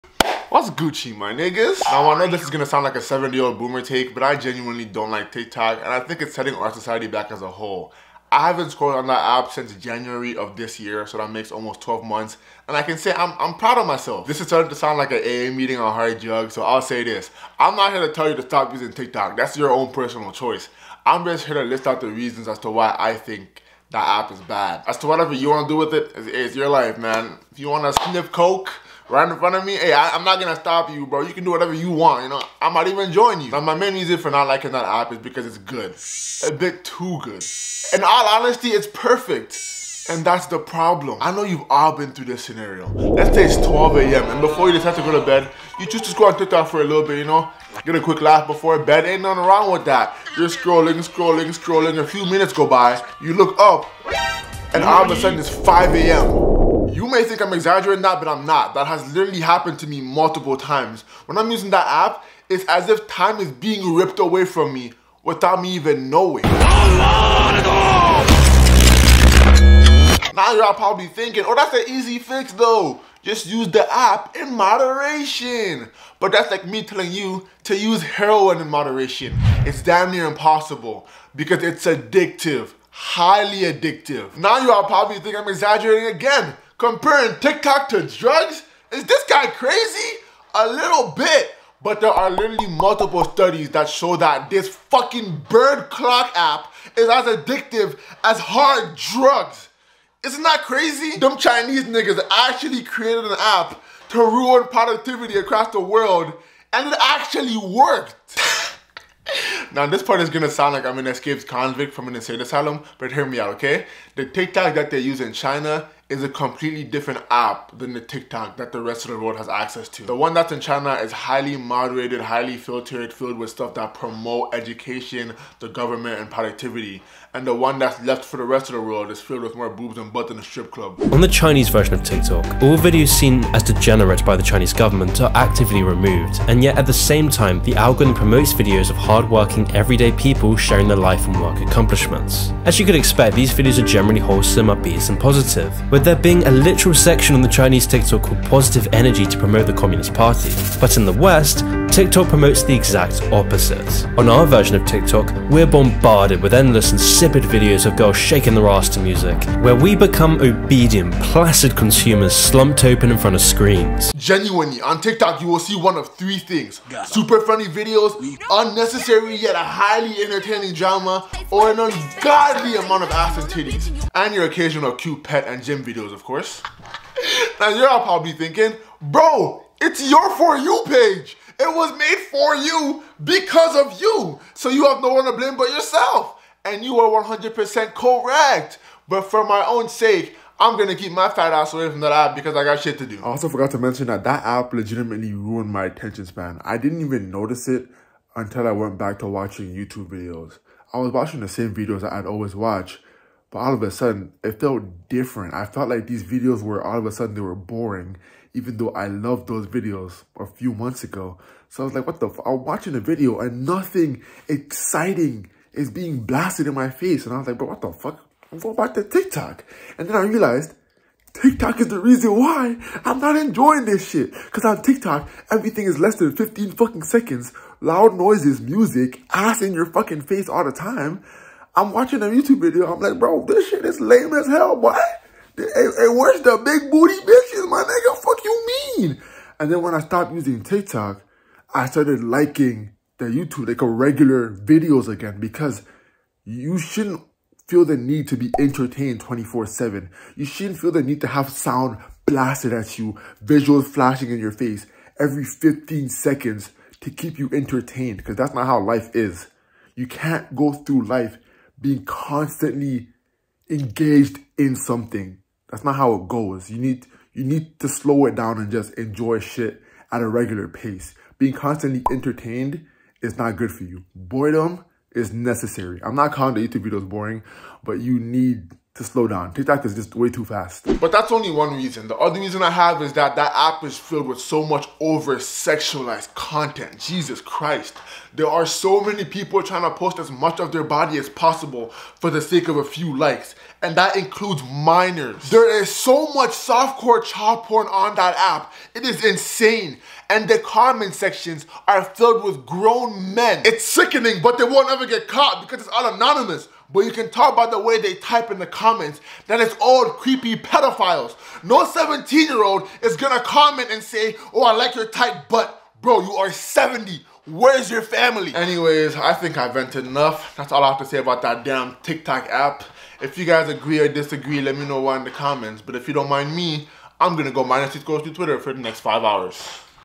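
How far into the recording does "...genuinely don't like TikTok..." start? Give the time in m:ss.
0:04.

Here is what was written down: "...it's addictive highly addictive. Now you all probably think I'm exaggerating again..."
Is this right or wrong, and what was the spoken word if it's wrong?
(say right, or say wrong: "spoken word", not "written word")
right.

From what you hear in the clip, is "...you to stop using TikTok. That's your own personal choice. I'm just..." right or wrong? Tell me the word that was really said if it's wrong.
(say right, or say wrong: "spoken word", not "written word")
right.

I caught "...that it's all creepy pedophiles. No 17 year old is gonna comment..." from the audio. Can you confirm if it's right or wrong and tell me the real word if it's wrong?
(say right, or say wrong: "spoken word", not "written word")
right.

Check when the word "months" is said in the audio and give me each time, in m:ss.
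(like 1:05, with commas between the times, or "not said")
0:12, 3:30.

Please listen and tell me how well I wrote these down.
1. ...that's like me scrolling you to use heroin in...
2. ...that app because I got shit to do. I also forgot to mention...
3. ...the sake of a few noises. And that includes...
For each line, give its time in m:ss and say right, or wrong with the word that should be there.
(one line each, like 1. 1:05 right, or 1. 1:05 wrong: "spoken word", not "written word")
1. 1:16 wrong: "telling", not "scrolling"
2. 3:12 right
3. 4:52 wrong: "likes", not "noises".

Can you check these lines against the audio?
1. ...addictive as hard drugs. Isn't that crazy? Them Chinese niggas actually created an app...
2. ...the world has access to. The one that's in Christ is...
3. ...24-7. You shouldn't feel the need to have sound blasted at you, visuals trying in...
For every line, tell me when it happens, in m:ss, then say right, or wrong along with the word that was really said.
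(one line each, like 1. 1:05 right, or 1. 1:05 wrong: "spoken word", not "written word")
1. 1:37 right
2. 1:59 wrong: "China", not "Christ"
3. 4:09 wrong: "flashing", not "trying".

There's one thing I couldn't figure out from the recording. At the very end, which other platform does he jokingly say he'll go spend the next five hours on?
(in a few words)
Twitter.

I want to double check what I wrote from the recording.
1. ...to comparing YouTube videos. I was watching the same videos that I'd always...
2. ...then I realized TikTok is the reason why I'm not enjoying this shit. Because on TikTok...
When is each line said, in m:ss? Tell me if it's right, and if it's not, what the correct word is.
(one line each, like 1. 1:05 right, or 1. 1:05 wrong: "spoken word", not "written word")
1. 3:19 wrong: "watching", not "comparing"
2. 3:40 right.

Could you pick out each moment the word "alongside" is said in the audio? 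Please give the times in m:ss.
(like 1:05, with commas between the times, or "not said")
not said.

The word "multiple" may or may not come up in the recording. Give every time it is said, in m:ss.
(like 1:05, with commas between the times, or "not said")
1:00, 1:32.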